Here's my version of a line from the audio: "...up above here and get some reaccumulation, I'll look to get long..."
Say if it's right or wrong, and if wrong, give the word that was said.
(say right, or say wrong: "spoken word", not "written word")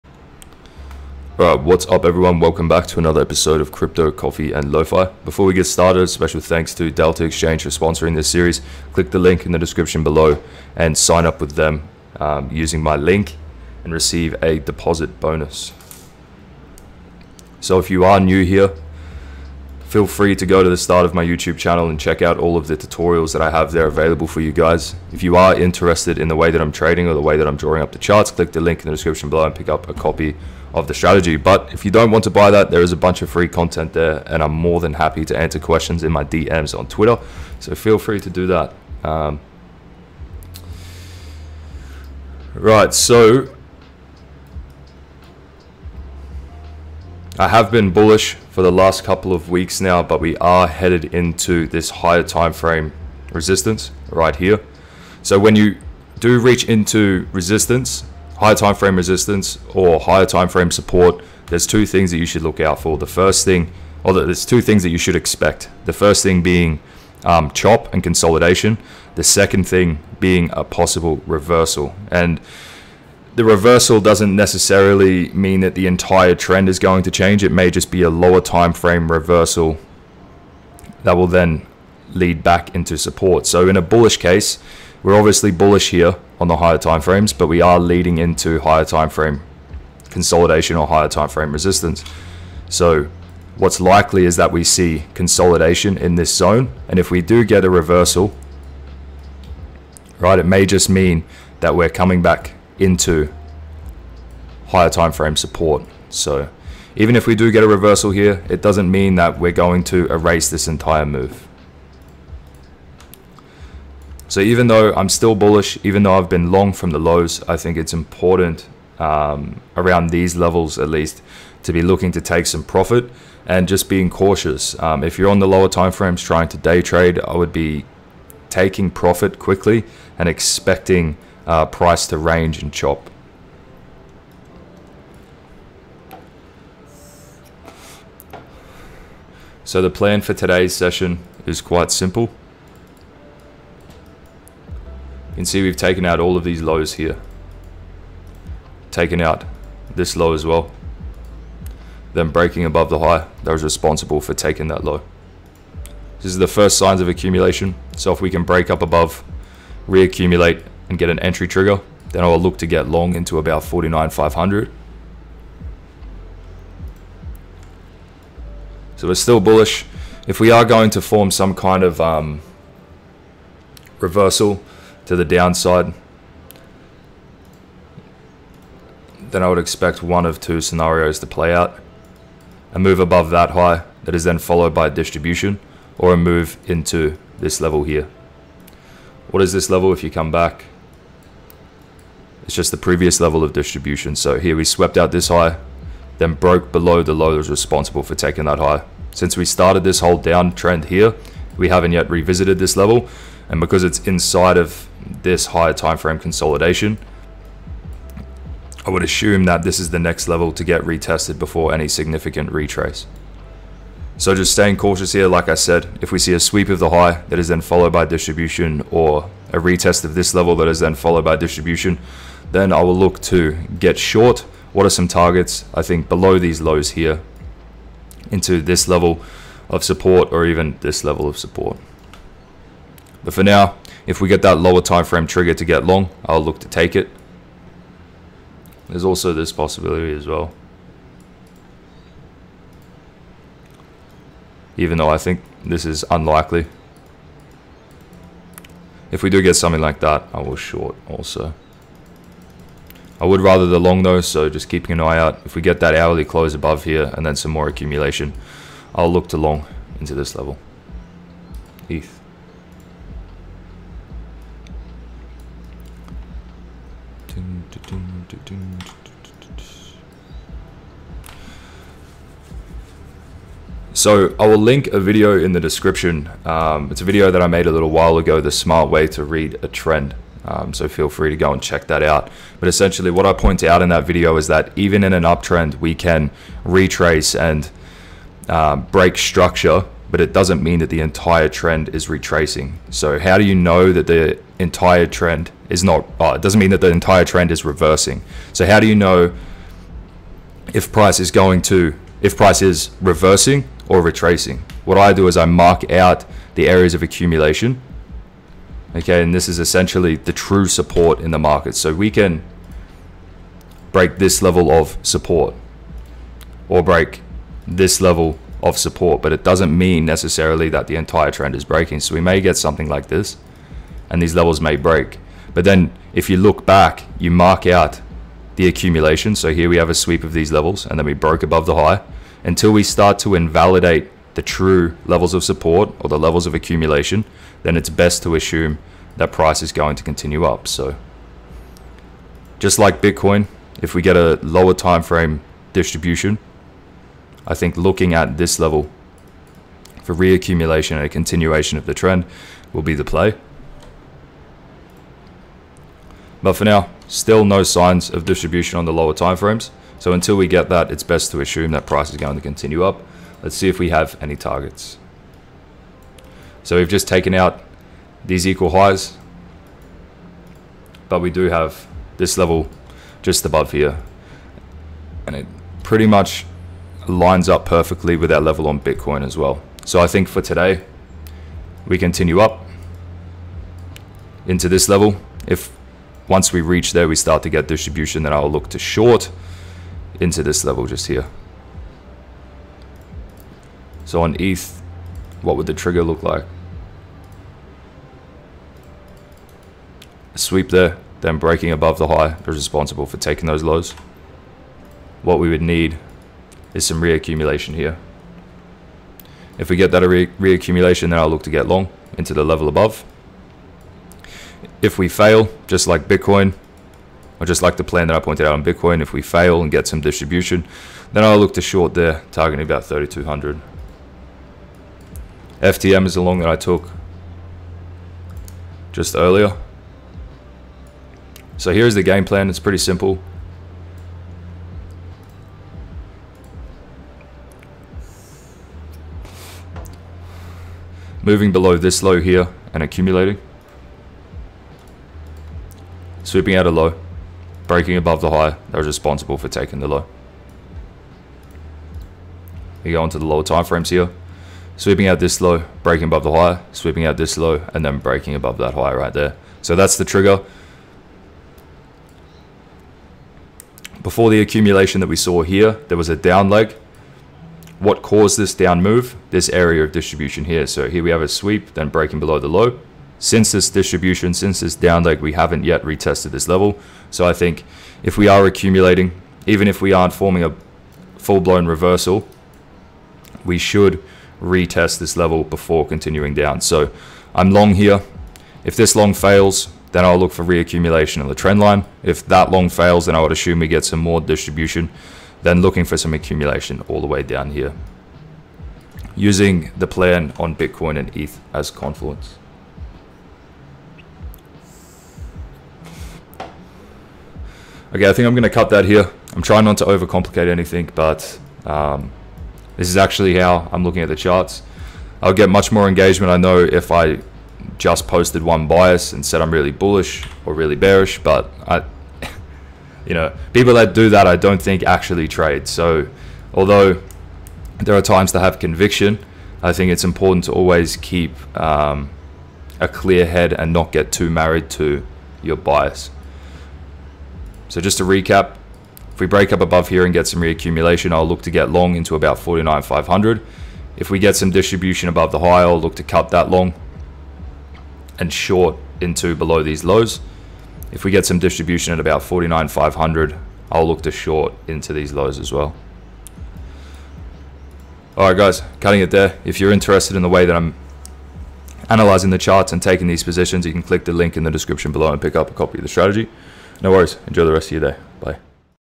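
right.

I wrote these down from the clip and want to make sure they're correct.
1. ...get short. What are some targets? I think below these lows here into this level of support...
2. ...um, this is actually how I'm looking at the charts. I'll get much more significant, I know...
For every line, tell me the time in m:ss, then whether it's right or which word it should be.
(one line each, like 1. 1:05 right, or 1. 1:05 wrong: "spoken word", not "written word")
1. 3:43 right
2. 8:31 wrong: "engagement", not "significant".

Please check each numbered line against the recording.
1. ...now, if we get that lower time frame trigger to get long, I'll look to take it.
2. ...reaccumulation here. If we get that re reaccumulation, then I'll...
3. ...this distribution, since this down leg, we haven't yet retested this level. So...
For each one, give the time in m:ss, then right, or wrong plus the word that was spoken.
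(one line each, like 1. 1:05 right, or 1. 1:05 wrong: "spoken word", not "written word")
1. 3:53 right
2. 6:47 right
3. 7:53 right.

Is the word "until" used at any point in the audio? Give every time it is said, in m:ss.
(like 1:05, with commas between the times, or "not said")
5:32, 6:00.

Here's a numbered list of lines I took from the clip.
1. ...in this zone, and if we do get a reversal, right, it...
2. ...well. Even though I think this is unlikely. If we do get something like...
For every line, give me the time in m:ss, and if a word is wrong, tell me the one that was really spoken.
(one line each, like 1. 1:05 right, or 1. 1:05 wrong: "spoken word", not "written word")
1. 1:35 right
2. 4:00 right.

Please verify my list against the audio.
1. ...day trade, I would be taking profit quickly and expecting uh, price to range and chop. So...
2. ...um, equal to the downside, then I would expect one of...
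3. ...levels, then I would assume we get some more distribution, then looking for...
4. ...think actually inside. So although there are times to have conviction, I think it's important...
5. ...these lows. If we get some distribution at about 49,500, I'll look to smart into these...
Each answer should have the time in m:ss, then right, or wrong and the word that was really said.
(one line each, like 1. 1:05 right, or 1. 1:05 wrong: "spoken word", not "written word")
1. 2:06 right
2. 2:52 wrong: "reversal", not "equal"
3. 8:12 wrong: "fails", not "levels"
4. 8:44 wrong: "trade", not "inside"
5. 9:09 wrong: "short", not "smart".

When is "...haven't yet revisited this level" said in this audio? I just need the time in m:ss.
3:21.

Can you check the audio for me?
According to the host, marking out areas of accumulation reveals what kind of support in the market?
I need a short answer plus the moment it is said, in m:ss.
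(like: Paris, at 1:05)
True support, at 5:10.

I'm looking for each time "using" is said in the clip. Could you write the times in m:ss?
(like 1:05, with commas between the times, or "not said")
0:12, 8:19.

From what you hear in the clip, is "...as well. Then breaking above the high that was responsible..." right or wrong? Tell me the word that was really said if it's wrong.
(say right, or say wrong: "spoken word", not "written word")
right.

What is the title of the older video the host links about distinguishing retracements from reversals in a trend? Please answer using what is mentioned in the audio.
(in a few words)
The smart way to read a trend.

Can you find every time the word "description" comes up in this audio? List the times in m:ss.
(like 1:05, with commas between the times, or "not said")
0:09, 0:28, 4:35, 9:24.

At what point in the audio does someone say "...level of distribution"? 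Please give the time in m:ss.
3:13.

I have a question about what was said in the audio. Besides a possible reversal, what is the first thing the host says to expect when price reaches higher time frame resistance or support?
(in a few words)
Chop and consolidation.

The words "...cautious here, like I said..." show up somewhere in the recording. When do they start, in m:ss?
3:34.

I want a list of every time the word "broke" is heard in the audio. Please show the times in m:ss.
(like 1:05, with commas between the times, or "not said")
3:16, 5:31.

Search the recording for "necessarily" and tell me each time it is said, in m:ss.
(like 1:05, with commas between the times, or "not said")
1:14, 5:20.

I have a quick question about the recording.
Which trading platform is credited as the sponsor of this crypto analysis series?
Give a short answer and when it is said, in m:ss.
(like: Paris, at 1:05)
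Delta Exchange, at 0:06.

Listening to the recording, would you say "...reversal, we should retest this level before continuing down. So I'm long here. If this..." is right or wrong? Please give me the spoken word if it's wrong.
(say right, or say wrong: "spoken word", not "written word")
right.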